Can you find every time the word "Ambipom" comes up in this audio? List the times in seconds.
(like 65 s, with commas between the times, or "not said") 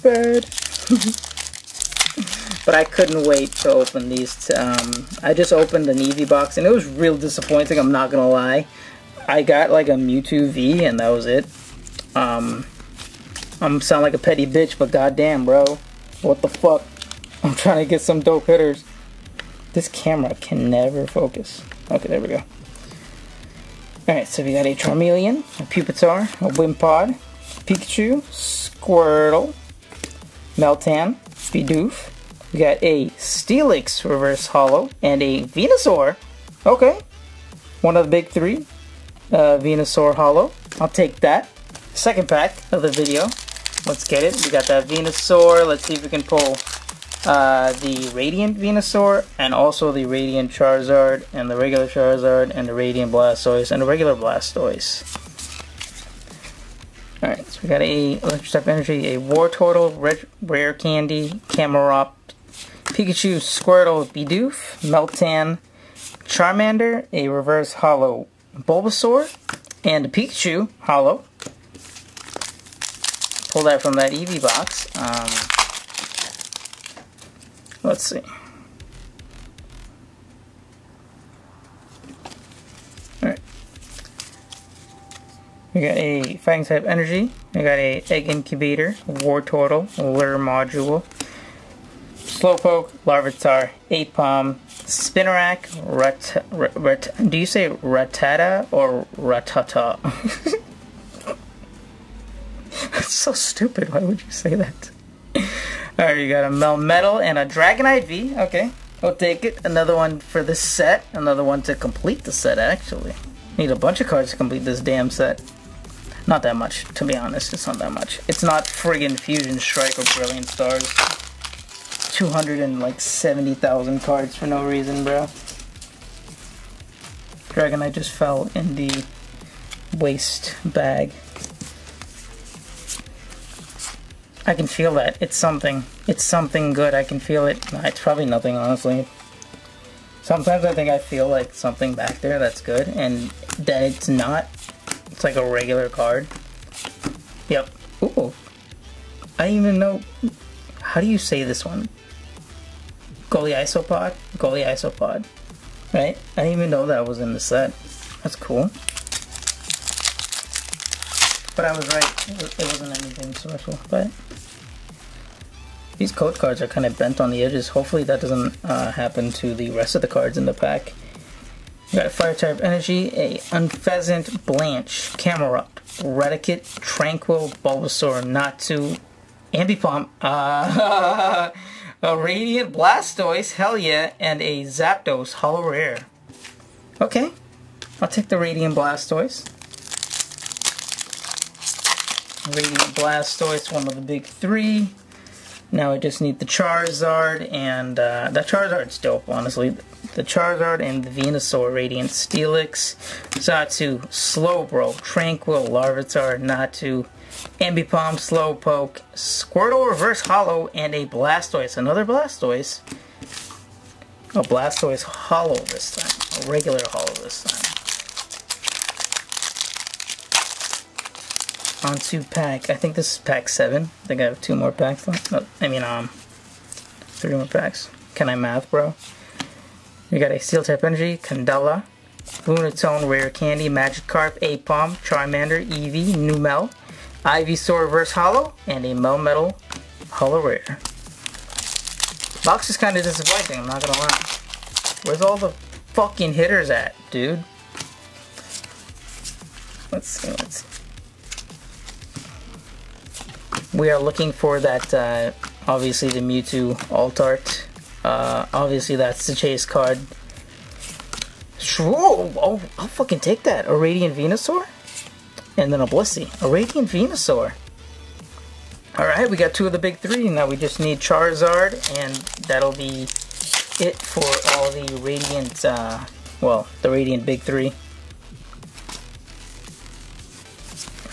179 s, 207 s.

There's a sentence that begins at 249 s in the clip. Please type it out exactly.
Let's see, let's see we are looking for that, uh, obviously the Mewtwo alt art.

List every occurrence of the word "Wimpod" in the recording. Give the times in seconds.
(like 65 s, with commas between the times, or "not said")
26 s.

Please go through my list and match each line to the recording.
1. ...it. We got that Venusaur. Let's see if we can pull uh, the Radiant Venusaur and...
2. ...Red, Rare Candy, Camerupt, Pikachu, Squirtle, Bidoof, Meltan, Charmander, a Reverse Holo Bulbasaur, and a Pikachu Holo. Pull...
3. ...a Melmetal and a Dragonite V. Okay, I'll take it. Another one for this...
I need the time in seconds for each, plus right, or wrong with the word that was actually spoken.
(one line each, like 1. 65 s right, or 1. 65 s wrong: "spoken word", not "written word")
1. 44 s right
2. 59 s right
3. 106 s right.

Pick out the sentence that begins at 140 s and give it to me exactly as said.
Sometimes I think I feel like something back there that's good, and then it's not.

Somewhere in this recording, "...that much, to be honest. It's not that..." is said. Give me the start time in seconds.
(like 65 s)
116 s.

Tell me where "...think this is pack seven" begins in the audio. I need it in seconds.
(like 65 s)
222 s.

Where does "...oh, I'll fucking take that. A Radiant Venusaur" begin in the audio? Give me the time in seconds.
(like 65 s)
262 s.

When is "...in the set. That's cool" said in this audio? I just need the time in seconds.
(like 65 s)
157 s.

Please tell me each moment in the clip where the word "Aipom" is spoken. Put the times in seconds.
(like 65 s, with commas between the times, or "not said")
93 s, 234 s.